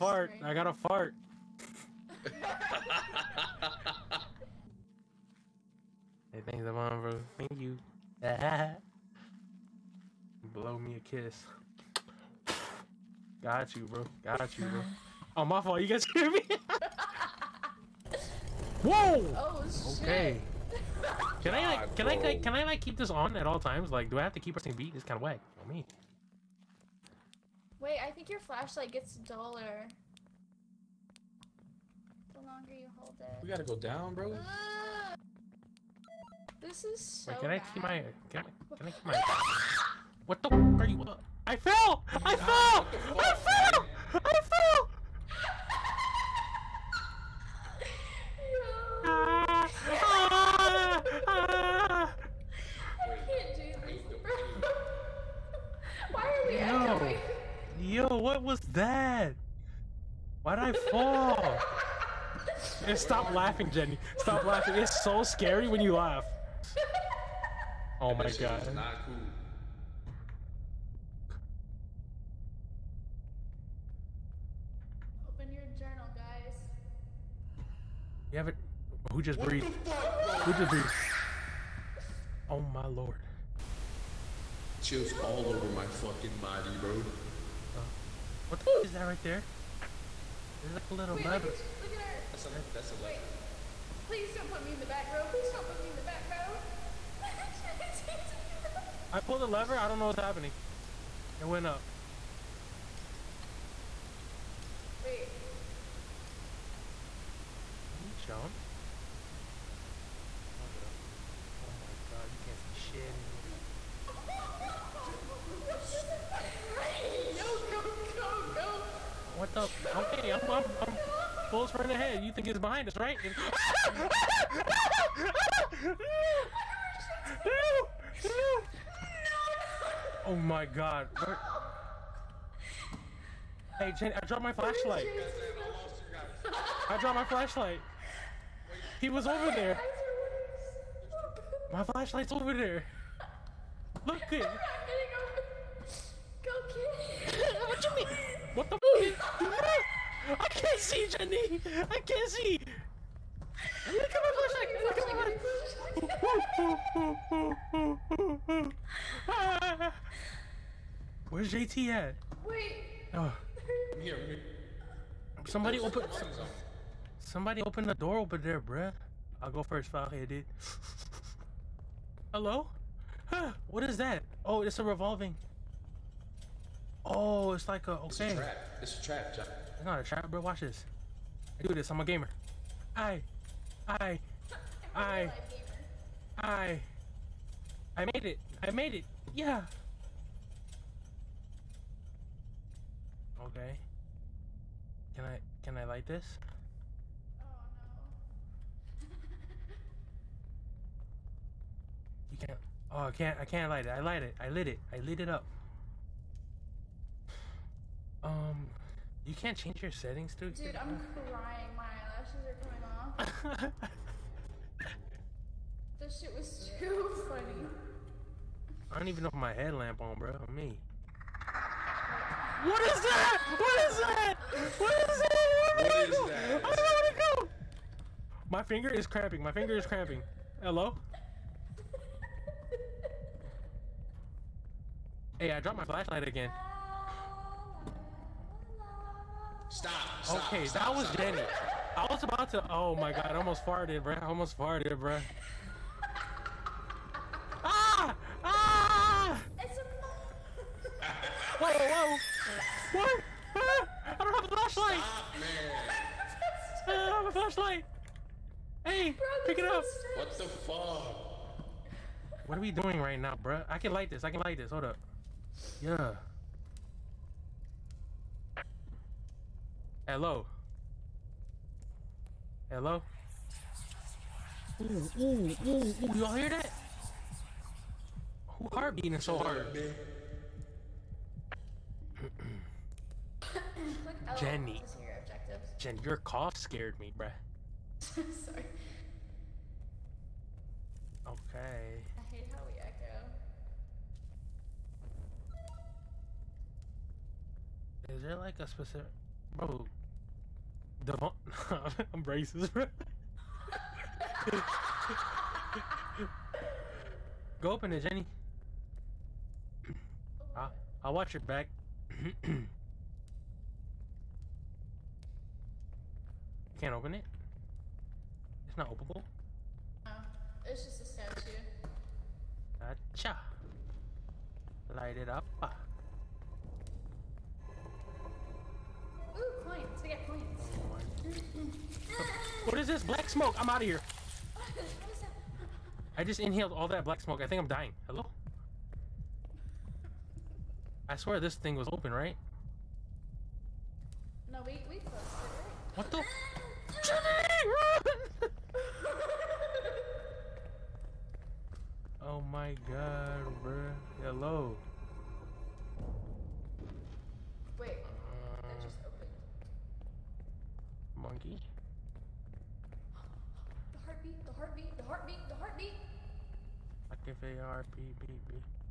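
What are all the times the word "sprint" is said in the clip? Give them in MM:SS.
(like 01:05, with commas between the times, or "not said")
02:01.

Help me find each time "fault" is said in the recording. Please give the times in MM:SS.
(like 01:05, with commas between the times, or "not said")
00:15.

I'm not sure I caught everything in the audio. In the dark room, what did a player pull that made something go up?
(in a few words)
the lever.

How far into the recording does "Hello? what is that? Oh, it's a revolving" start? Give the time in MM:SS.
02:52.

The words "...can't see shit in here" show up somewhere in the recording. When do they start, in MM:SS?
01:52.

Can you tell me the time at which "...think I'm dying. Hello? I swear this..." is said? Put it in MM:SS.
05:37.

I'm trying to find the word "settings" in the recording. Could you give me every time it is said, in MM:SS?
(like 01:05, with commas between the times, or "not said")
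03:29.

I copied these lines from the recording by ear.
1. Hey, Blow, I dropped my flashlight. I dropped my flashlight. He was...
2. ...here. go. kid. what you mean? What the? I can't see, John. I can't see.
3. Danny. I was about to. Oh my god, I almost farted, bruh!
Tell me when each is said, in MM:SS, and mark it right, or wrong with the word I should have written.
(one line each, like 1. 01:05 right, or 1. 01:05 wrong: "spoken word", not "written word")
1. 02:13 wrong: "Jenny", not "Blow"
2. 02:24 wrong: "Jenny", not "John"
3. 04:01 right.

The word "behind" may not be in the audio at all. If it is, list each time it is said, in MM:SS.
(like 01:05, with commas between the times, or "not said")
02:02.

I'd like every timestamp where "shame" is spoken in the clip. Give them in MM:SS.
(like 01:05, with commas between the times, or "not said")
not said.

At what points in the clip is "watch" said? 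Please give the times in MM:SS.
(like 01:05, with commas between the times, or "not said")
03:00, 05:11.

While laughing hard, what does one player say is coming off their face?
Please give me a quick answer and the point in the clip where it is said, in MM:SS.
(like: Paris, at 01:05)
eyelashes, at 03:31.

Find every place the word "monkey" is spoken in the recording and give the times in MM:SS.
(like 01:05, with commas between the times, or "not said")
06:01.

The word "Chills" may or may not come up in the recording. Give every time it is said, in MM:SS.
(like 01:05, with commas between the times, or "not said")
01:24.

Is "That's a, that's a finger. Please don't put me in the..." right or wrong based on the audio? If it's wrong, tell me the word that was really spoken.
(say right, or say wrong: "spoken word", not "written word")
wrong: "lever", not "finger".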